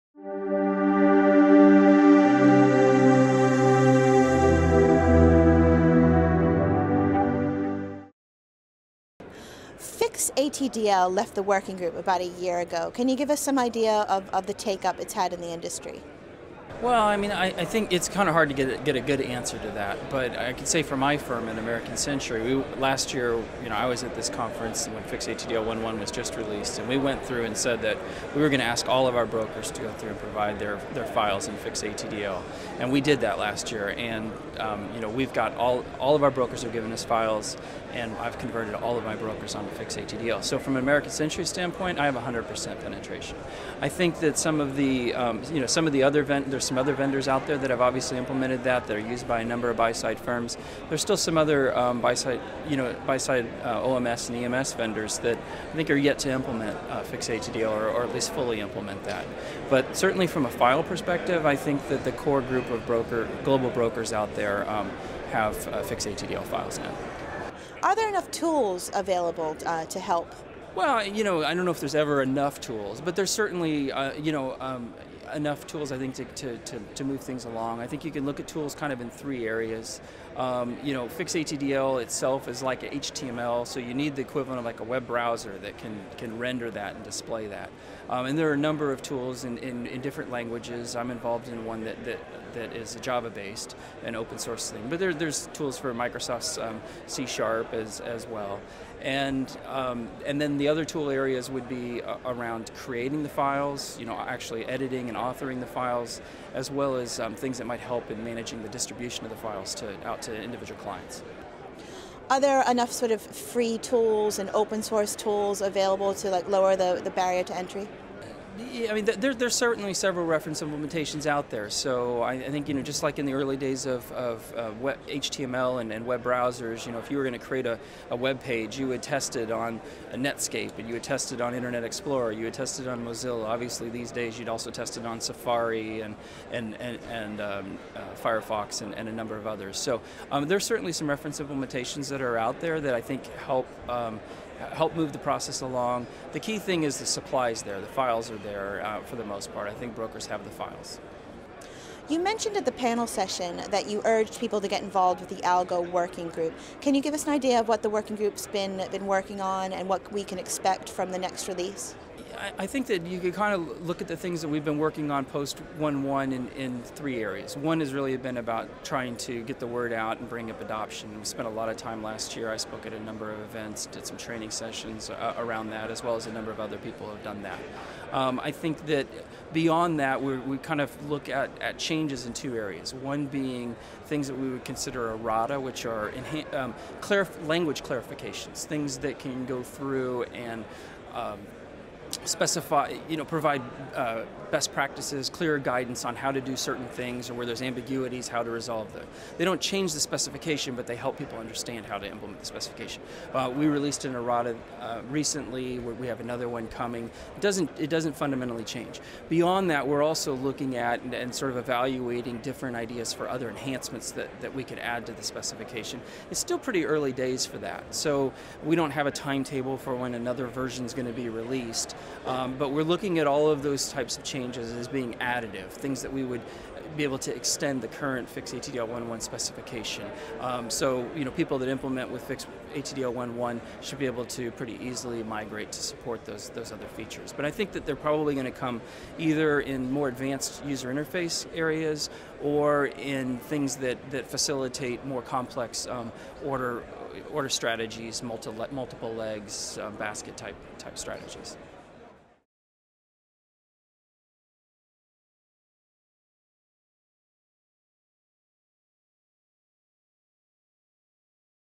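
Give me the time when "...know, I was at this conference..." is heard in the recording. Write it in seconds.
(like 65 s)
23 s.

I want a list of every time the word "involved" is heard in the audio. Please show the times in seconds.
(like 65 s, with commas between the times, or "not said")
91 s, 154 s.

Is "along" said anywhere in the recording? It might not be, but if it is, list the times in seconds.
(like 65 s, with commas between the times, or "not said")
77 s, 145 s.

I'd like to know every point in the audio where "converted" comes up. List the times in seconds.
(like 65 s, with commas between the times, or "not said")
38 s.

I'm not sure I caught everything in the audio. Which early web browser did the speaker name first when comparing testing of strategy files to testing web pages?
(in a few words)
Netscape.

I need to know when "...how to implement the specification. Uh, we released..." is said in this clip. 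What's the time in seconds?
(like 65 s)
201 s.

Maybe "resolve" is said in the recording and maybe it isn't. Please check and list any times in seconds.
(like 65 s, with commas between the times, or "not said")
198 s.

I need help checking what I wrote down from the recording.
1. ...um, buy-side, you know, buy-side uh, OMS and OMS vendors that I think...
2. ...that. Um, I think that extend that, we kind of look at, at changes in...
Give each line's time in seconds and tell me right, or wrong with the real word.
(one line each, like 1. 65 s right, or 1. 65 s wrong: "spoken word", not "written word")
1. 51 s wrong: "EMS", not "OMS"
2. 177 s wrong: "beyond", not "extend".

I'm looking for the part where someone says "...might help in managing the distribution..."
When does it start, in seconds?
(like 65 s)
107 s.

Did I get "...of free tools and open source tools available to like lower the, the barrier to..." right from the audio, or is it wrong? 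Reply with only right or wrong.
right.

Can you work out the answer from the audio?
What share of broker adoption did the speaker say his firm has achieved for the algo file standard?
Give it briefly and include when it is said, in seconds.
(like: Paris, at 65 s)
100%, at 42 s.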